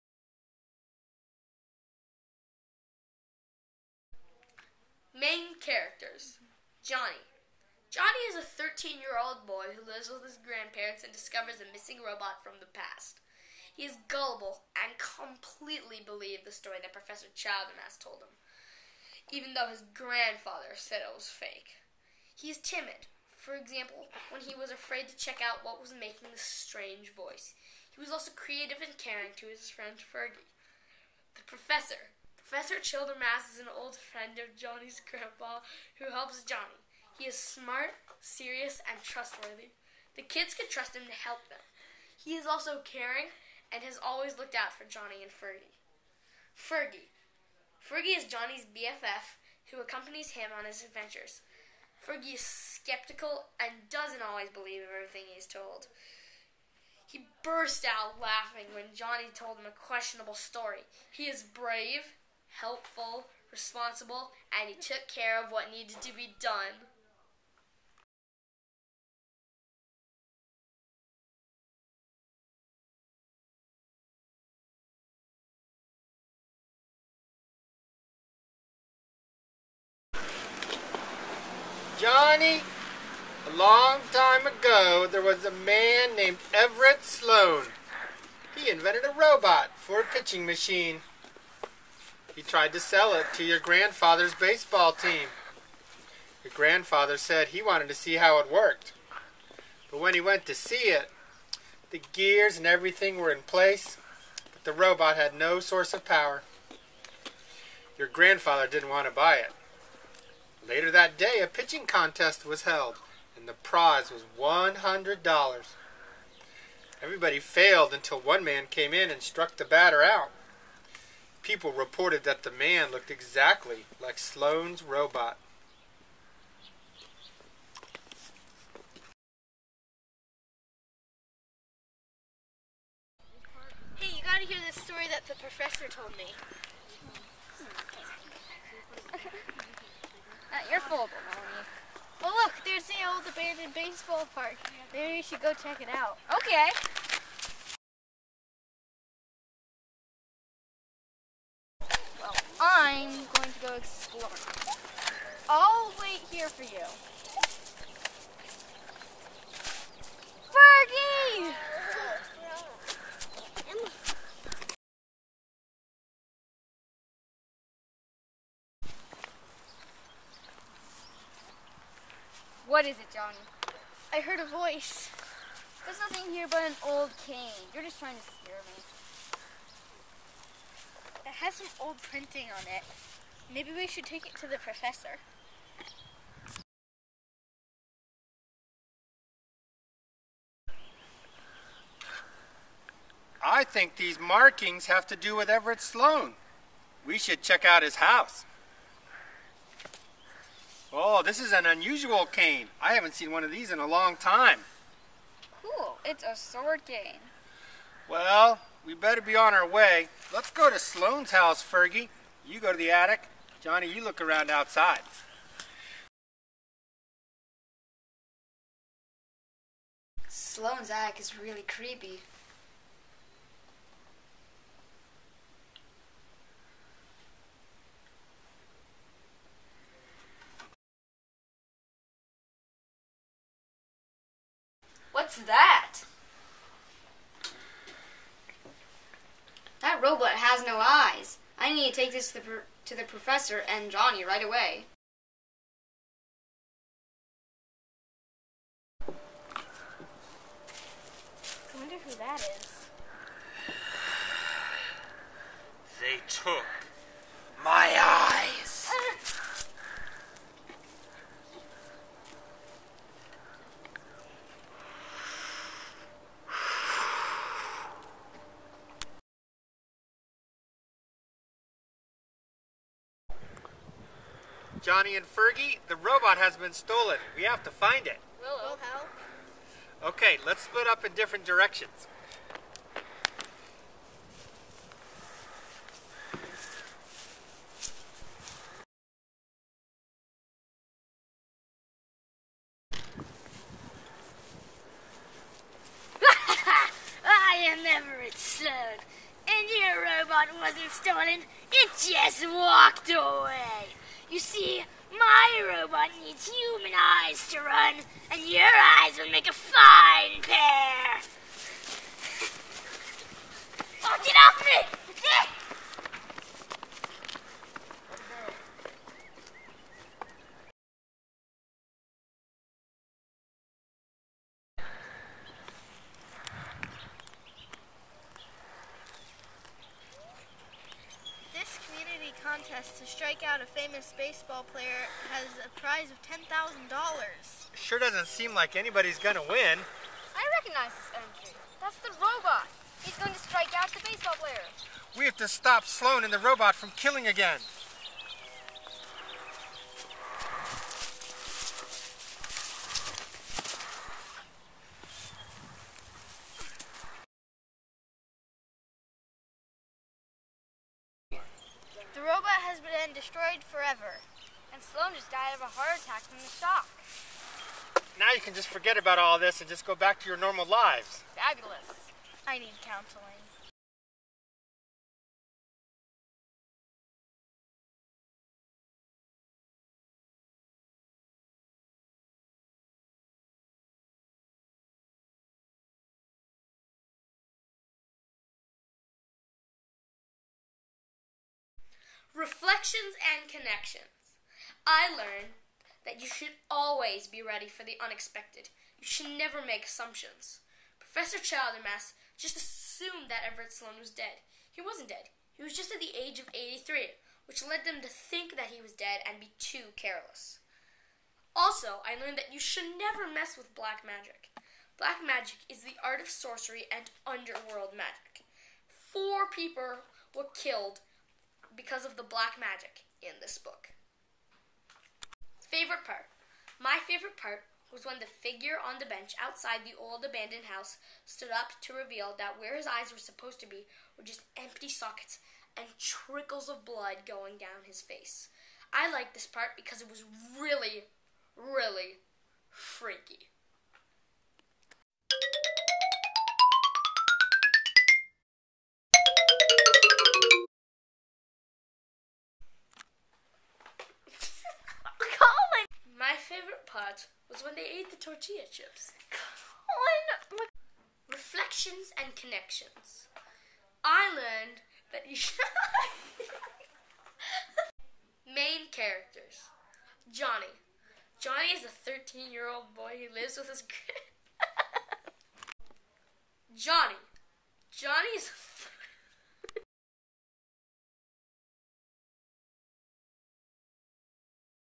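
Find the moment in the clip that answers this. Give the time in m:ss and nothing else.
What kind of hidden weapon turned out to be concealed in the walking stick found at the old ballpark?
3:26.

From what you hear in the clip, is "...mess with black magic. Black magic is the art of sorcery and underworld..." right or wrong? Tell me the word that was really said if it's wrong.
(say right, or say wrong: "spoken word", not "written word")
right.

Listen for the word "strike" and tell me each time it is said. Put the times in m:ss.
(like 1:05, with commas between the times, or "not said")
5:33, 5:43.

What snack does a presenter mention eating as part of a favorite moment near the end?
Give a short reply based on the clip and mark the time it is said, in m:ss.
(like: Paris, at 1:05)
tortilla chips, at 7:38.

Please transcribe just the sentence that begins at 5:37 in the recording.
Sure doesn't seem like anybody's gonna win.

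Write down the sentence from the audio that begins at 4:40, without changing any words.
Okay, let's split up in different directions.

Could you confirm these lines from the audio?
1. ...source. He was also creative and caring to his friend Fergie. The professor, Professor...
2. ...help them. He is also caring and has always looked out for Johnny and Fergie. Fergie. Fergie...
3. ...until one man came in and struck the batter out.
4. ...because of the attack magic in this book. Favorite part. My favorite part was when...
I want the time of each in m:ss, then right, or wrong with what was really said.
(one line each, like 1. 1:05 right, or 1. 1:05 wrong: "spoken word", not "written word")
1. 0:27 wrong: "voice", not "source"
2. 0:41 right
3. 1:57 right
4. 7:01 wrong: "black", not "attack".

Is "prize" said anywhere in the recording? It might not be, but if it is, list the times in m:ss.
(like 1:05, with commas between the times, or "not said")
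1:53, 5:35.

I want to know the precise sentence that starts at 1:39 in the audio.
But when he went to see it, the gears and everything were in place, but the robot had no source of power.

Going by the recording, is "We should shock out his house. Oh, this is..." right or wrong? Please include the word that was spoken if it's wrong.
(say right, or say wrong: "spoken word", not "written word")
wrong: "check", not "shock".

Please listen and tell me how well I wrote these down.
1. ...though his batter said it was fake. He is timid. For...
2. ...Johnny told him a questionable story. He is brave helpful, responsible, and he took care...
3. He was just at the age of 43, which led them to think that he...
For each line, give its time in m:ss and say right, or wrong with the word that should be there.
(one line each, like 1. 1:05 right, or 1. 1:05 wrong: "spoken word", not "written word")
1. 0:19 wrong: "grandfather", not "batter"
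2. 0:58 right
3. 6:45 wrong: "83", not "43".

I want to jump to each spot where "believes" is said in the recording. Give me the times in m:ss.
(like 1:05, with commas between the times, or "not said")
0:16, 0:54.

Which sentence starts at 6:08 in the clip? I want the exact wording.
Now you can just forget about all this and just go back to your normal lives.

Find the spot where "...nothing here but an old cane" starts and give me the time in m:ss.
2:56.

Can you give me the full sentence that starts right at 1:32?
He tried to sell it to your grandfather's baseball team.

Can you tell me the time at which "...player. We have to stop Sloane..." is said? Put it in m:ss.
5:44.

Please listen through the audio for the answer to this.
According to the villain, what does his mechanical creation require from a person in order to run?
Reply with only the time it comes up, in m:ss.
5:06.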